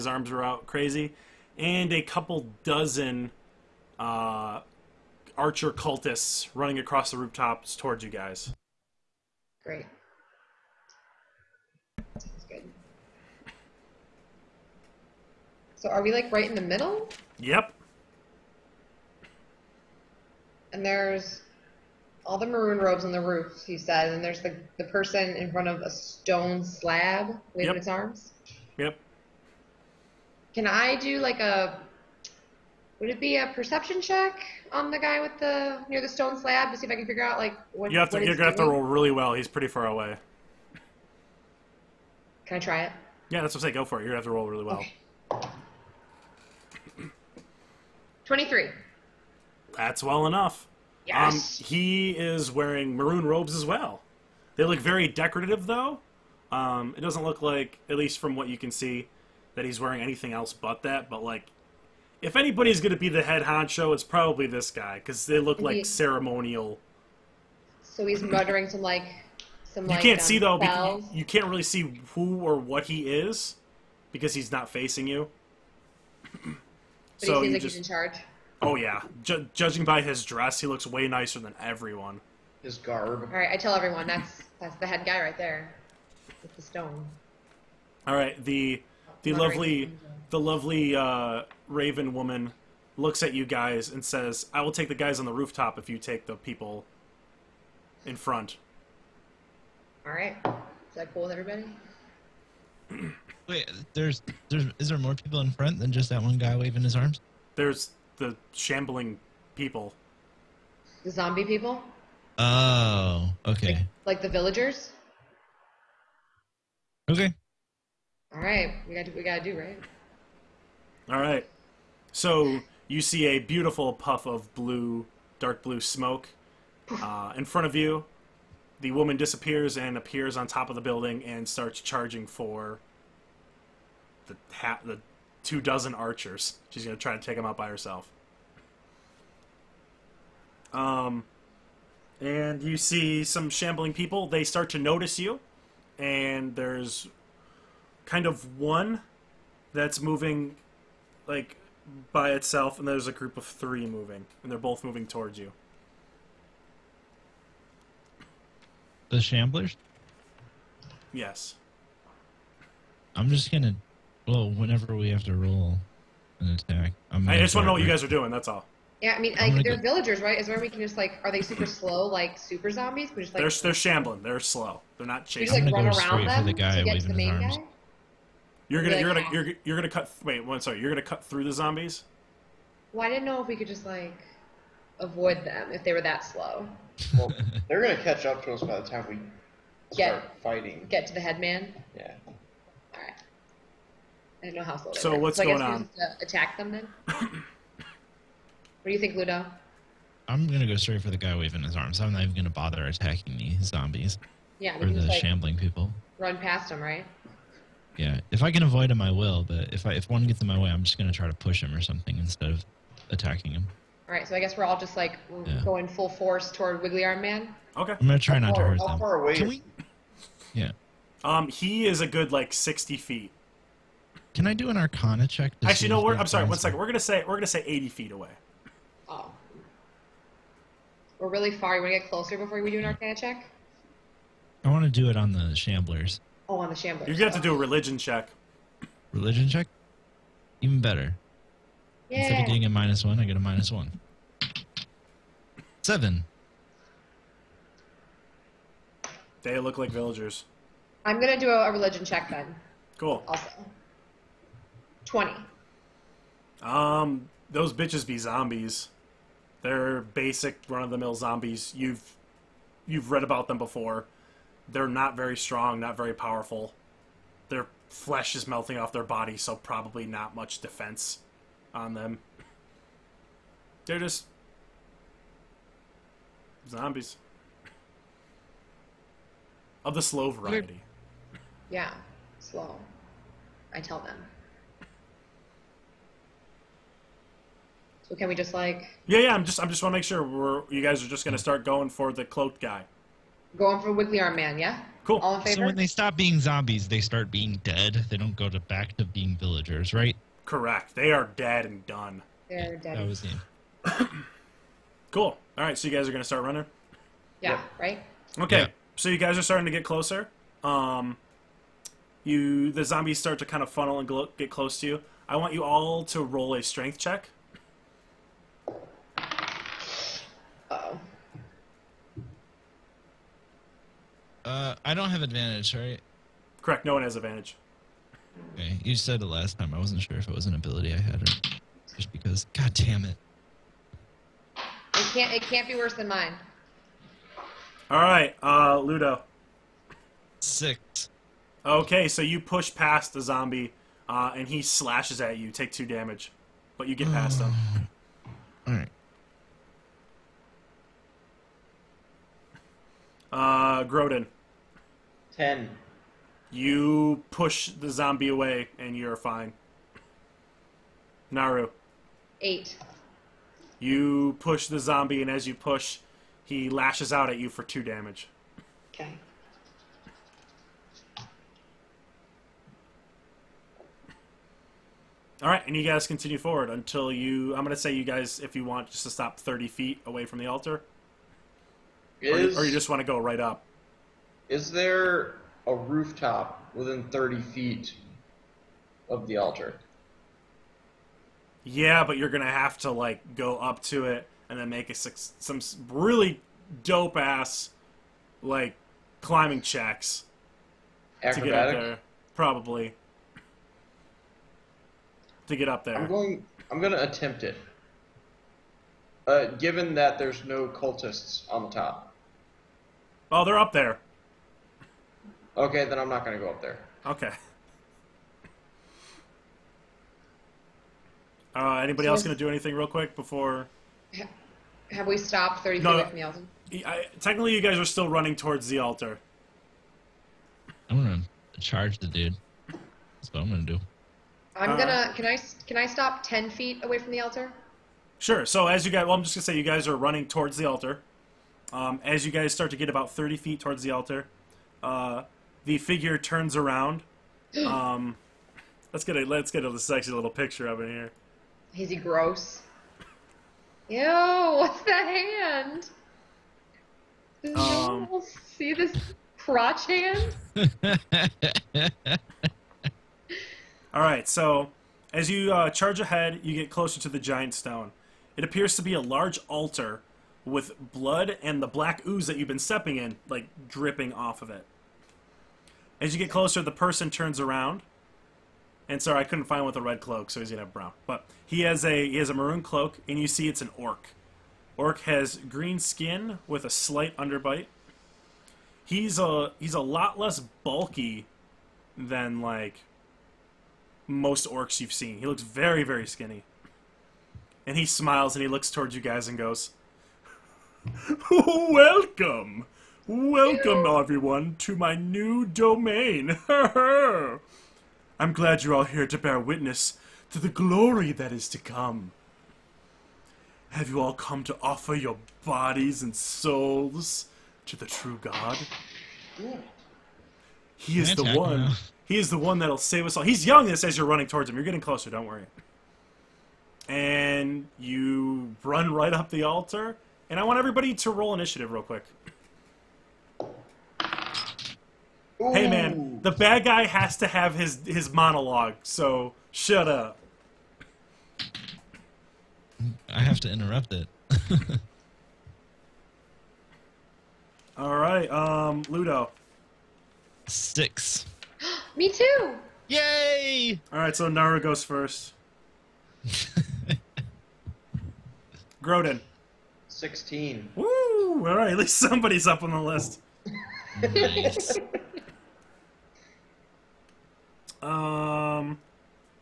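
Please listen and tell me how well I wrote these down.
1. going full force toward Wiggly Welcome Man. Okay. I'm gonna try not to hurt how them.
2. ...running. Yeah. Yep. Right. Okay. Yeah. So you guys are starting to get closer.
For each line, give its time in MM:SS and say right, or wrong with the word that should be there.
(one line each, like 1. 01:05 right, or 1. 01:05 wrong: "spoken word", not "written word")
1. 03:35 wrong: "Arm", not "Welcome"
2. 05:06 right.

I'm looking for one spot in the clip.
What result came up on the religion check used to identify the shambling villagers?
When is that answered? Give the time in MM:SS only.
04:15.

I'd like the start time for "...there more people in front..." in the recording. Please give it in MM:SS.
01:44.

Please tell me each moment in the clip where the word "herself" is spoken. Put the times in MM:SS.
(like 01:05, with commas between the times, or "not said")
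02:17.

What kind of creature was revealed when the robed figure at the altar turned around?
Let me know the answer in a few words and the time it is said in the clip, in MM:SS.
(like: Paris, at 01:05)
An orc, at 08:03.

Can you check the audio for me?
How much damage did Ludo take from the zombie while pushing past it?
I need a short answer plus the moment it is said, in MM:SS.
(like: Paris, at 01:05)
2, at 05:45.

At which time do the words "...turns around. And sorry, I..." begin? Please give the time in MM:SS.
07:57.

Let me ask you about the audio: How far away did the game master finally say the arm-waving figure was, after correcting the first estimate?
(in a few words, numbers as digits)
80 feet.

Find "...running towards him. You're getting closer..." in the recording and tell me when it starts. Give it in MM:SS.
08:44.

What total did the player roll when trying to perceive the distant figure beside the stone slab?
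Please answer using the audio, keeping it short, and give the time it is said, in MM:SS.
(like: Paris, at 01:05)
23, at 00:48.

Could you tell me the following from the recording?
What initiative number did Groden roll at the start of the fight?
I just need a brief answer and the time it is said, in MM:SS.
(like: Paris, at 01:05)
16, at 09:19.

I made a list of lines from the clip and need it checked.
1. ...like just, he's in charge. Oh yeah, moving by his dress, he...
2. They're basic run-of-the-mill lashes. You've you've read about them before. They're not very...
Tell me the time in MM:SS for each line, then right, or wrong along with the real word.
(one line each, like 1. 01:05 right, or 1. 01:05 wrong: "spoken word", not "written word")
1. 01:17 wrong: "judging", not "moving"
2. 04:19 wrong: "zombies", not "lashes".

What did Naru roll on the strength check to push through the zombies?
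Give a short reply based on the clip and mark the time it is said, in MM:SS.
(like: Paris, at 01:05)
8, at 06:02.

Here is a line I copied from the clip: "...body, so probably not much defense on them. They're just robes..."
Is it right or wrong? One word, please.
wrong.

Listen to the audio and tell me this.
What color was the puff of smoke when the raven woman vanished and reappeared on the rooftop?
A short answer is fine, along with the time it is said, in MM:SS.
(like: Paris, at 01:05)
Dark blue, at 02:05.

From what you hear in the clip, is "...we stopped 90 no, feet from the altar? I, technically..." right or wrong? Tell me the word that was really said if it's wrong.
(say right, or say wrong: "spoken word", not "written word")
wrong: "30", not "90".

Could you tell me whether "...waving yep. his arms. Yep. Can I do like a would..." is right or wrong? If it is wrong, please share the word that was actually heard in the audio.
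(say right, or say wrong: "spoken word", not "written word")
right.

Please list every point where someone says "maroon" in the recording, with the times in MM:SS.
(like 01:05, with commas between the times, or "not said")
00:22, 00:52, 08:02.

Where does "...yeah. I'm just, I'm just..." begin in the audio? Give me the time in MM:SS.
04:49.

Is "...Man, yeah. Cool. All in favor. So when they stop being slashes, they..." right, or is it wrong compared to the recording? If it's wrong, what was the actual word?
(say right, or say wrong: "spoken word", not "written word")
wrong: "zombies", not "slashes".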